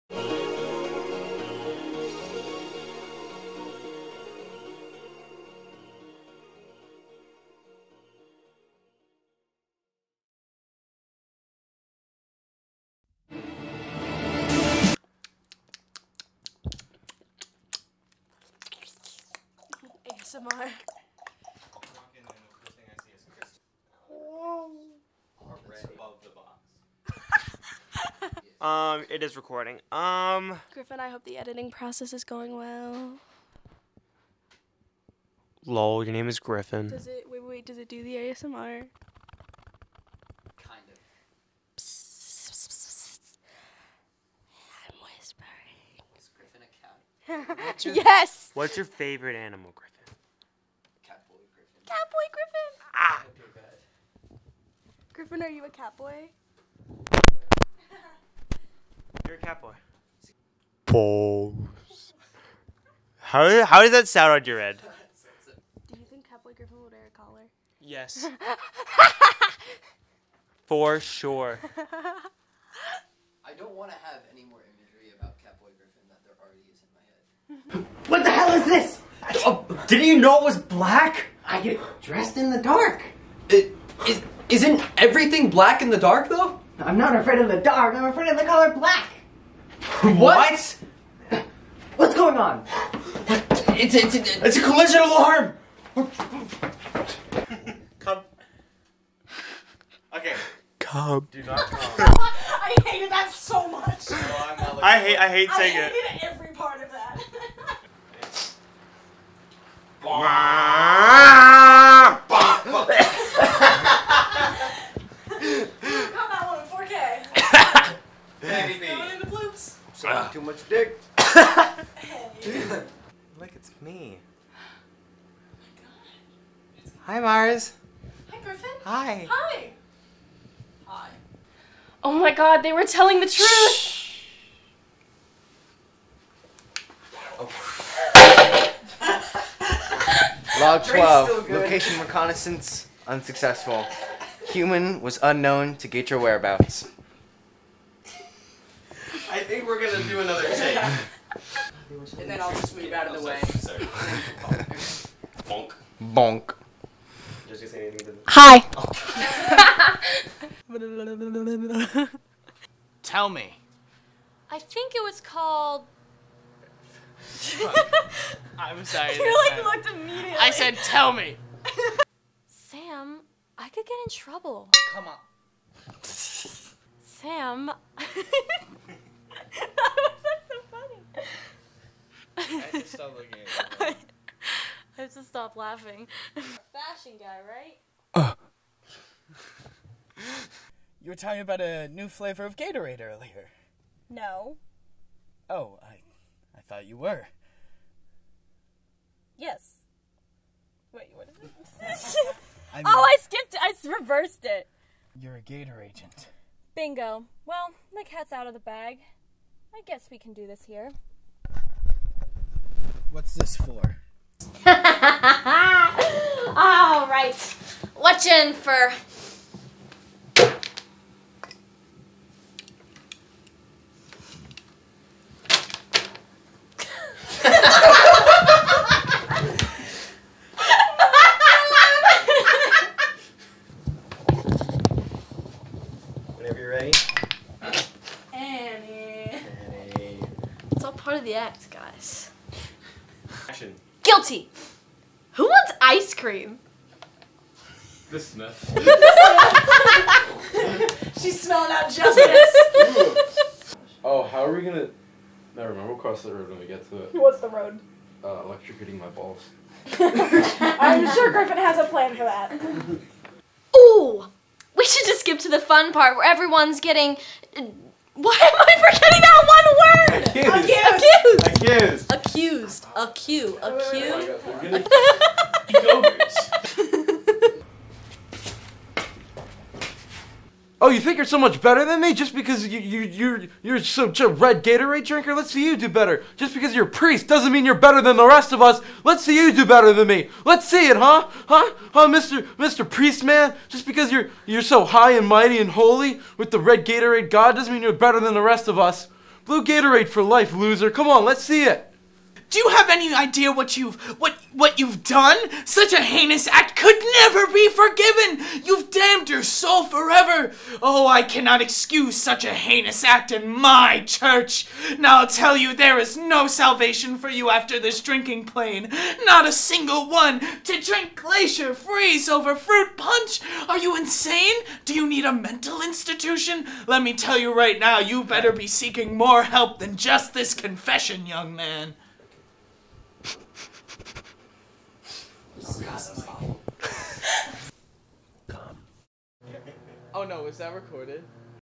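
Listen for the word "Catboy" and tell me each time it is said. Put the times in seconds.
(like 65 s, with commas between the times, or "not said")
66 s, 75 s.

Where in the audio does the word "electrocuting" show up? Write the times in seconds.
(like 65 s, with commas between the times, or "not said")
258 s.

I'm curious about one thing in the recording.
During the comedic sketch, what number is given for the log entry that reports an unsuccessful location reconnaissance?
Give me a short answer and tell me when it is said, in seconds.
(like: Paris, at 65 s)
12, at 140 s.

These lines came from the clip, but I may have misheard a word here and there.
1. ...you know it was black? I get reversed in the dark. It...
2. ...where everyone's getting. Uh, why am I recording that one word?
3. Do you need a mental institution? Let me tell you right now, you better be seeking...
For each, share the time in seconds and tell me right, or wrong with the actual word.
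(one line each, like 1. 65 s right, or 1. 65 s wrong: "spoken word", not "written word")
1. 80 s wrong: "dressed", not "reversed"
2. 266 s wrong: "forgetting", not "recording"
3. 324 s right.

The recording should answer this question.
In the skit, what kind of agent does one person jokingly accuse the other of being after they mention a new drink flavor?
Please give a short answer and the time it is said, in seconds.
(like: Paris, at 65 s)
Gator agent, at 205 s.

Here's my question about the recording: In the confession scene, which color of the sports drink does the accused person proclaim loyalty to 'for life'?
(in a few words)
Blue.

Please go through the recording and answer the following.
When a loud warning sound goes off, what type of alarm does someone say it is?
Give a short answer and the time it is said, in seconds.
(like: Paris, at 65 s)
Collision alarm, at 94 s.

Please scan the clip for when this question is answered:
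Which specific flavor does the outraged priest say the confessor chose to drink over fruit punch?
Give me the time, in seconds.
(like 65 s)
321 s.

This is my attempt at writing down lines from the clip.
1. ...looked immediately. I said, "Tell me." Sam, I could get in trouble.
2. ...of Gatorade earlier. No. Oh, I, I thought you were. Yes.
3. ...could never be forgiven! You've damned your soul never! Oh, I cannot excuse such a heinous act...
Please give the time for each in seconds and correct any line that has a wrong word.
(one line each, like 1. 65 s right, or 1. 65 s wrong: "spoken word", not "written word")
1. 169 s right
2. 192 s right
3. 306 s wrong: "forever", not "never".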